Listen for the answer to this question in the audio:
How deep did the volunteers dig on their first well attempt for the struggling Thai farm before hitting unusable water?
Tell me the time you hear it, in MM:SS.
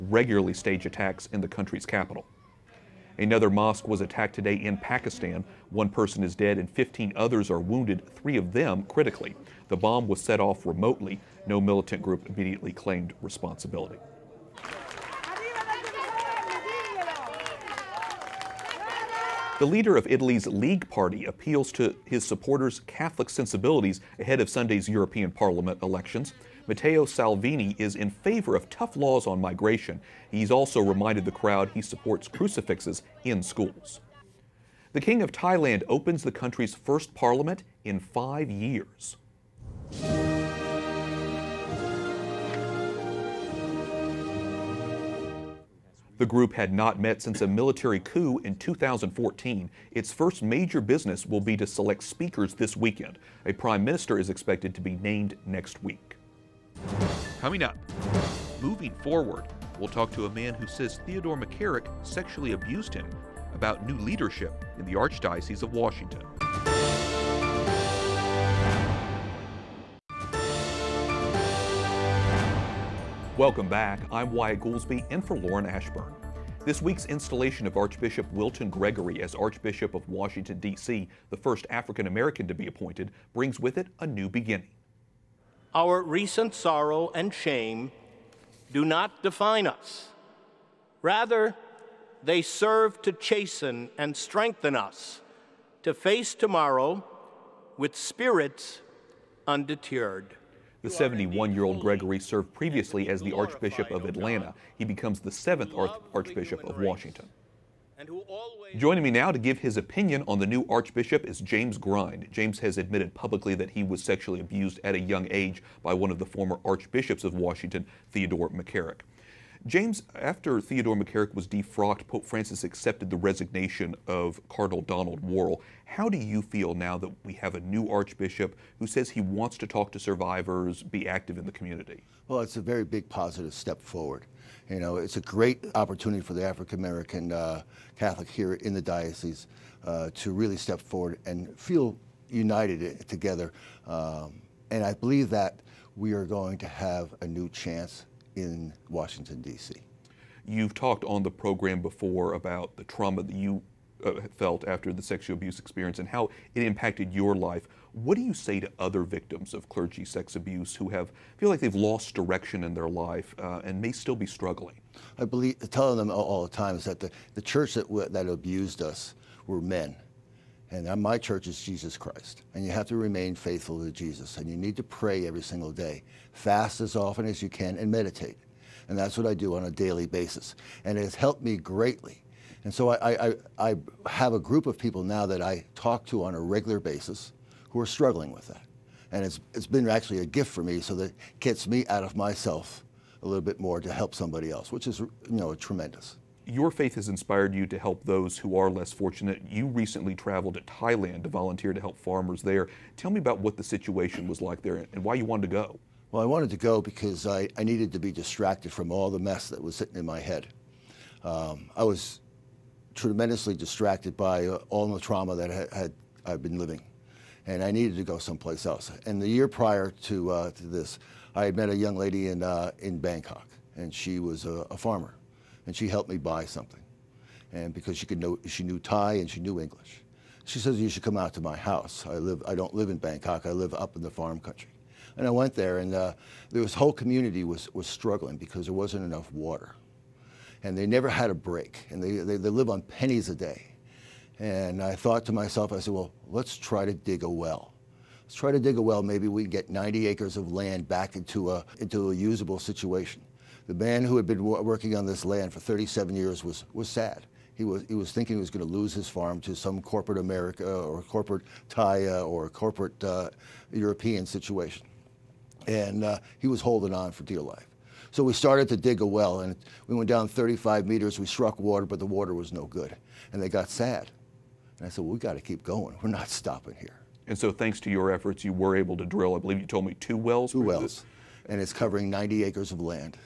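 04:30.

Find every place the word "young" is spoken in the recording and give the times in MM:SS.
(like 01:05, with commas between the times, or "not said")
01:54, 03:41.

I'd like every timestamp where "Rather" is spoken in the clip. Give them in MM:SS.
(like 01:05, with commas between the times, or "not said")
01:31.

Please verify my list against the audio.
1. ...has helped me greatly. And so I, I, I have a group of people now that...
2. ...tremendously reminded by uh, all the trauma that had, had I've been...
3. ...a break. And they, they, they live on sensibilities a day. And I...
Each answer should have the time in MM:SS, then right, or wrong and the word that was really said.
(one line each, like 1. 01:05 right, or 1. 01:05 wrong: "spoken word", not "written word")
1. 03:01 right
2. 03:32 wrong: "distracted", not "reminded"
3. 04:01 wrong: "pennies", not "sensibilities".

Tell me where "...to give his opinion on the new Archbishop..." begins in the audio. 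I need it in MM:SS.
01:49.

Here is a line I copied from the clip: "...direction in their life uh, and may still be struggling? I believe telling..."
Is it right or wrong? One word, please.
right.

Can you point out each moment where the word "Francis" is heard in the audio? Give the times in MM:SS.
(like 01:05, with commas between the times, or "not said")
02:02.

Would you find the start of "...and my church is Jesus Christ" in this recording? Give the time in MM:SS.
02:50.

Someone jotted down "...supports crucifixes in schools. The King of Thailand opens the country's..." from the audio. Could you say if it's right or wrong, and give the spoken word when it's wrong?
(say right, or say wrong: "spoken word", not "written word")
right.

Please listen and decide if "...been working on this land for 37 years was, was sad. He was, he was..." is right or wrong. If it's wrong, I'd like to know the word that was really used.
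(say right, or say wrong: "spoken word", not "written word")
right.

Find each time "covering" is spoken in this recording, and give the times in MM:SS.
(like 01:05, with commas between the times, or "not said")
04:41.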